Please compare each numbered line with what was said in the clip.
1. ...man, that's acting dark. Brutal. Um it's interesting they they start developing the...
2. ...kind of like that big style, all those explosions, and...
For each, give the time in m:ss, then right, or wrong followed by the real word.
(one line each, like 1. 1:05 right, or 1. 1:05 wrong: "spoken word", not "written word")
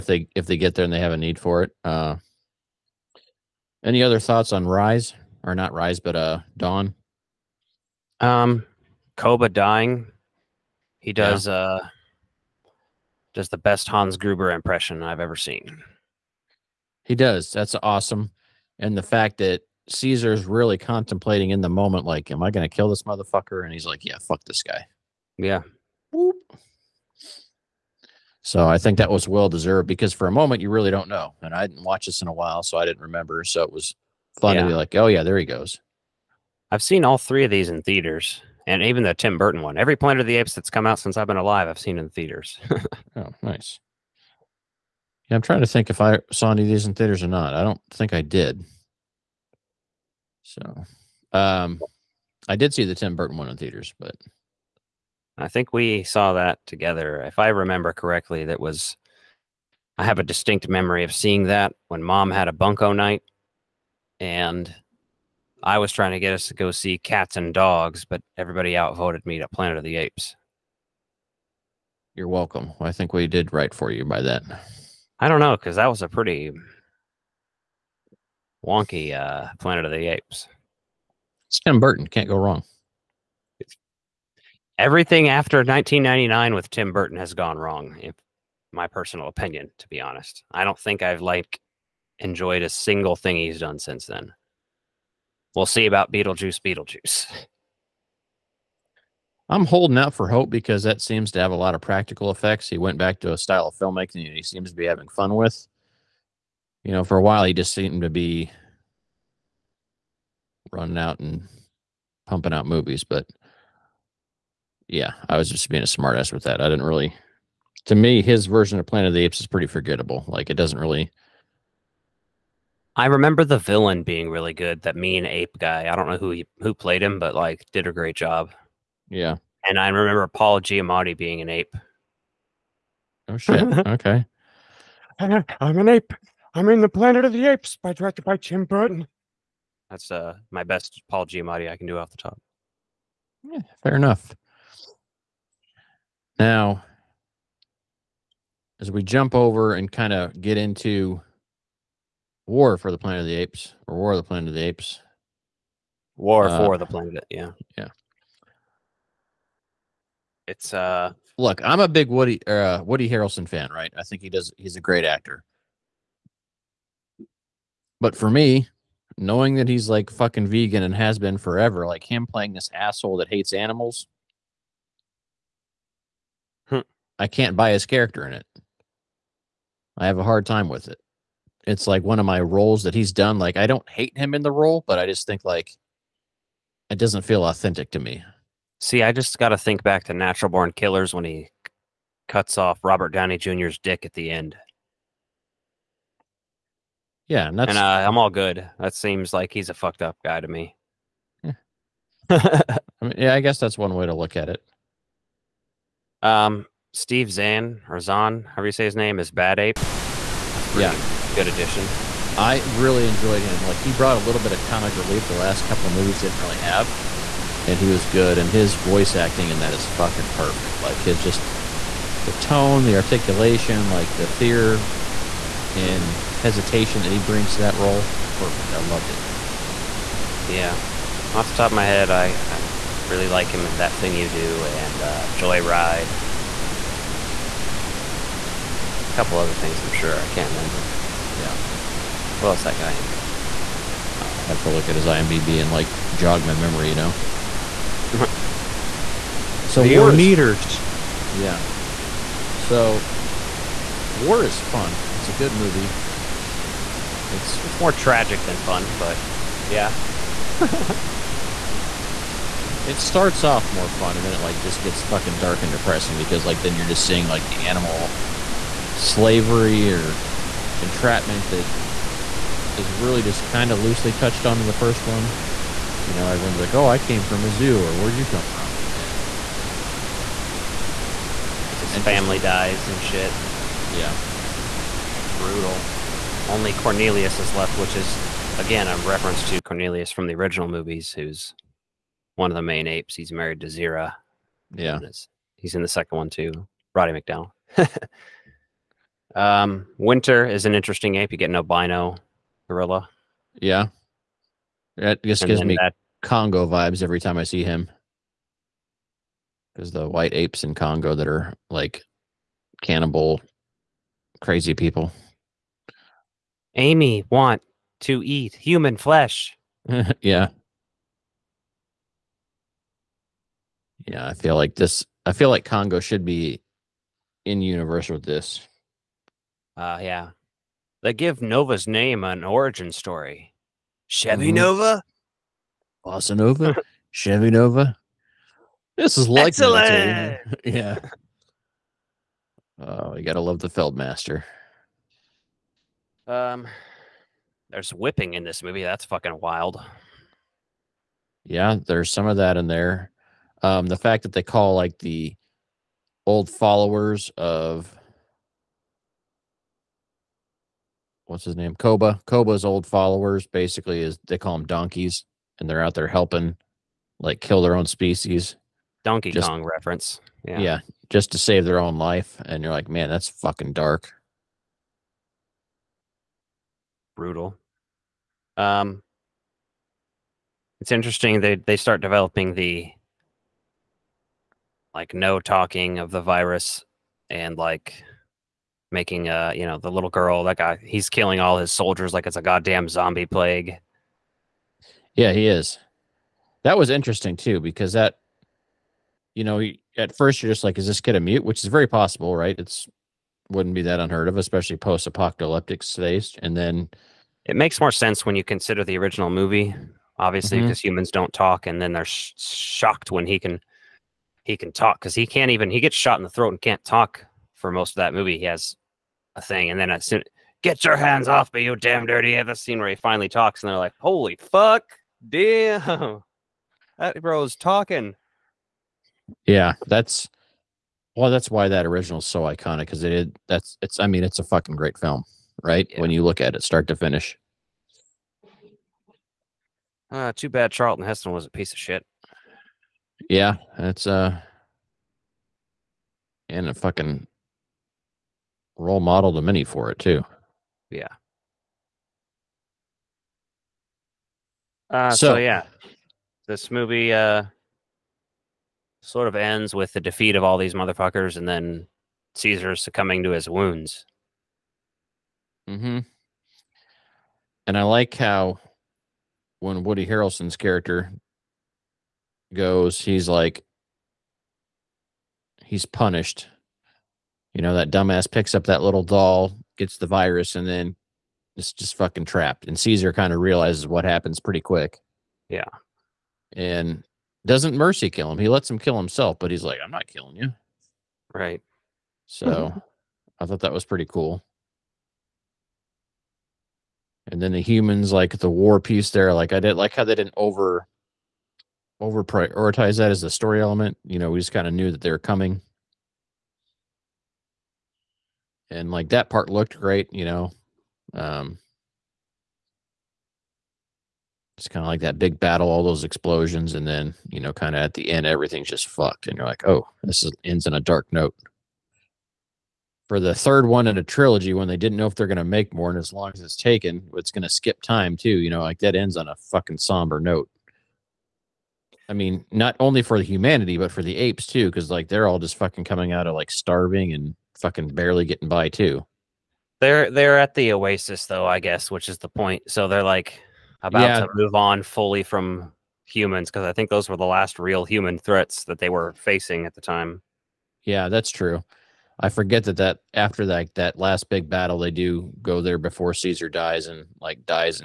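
1. 6:12 wrong: "fucking", not "acting"
2. 8:34 wrong: "battle", not "style".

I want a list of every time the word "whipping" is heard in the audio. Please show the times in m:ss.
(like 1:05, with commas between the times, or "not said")
5:47.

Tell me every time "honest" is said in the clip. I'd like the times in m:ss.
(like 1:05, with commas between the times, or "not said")
1:30.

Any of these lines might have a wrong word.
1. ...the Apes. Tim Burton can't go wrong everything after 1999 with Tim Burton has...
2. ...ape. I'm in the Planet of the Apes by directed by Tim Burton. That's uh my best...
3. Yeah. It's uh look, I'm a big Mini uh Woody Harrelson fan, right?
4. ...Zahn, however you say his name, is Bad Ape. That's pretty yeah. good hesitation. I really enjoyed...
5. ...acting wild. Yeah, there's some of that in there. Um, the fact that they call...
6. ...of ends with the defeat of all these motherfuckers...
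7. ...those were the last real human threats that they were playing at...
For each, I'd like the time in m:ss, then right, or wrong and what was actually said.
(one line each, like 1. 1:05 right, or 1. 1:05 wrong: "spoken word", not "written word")
1. 1:19 right
2. 2:15 right
3. 2:37 wrong: "Woody", not "Mini"
4. 3:28 wrong: "addition", not "hesitation"
5. 5:49 wrong: "fucking", not "acting"
6. 7:39 right
7. 9:06 wrong: "facing", not "playing".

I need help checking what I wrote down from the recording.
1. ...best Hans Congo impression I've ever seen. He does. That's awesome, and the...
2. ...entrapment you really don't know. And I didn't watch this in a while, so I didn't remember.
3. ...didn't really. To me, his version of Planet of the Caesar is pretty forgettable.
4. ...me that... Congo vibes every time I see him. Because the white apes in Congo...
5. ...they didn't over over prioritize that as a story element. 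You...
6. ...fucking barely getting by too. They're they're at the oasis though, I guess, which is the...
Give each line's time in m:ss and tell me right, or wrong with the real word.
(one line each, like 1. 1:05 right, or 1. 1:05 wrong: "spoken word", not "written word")
1. 0:13 wrong: "Gruber", not "Congo"
2. 0:30 wrong: "moment", not "entrapment"
3. 1:56 wrong: "Apes", not "Caesar"
4. 5:05 right
5. 8:20 right
6. 8:57 right.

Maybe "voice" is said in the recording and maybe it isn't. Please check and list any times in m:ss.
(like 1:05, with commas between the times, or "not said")
3:38.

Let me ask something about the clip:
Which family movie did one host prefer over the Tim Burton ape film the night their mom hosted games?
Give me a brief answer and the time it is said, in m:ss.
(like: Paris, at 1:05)
Cats and Dogs, at 1:06.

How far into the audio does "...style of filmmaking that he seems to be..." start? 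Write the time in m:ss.
1:43.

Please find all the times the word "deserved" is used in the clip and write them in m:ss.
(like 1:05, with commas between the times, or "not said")
0:29.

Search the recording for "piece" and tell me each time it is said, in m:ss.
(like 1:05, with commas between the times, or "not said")
7:21, 8:18.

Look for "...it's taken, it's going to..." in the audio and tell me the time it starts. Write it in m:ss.
8:46.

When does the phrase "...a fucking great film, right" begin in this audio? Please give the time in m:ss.
7:14.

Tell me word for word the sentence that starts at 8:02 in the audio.
And Caesar kind of realizes what happens pretty quick.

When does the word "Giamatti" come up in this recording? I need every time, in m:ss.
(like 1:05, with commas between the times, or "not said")
2:10, 2:21.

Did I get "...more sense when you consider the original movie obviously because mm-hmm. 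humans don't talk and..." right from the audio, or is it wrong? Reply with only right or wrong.
right.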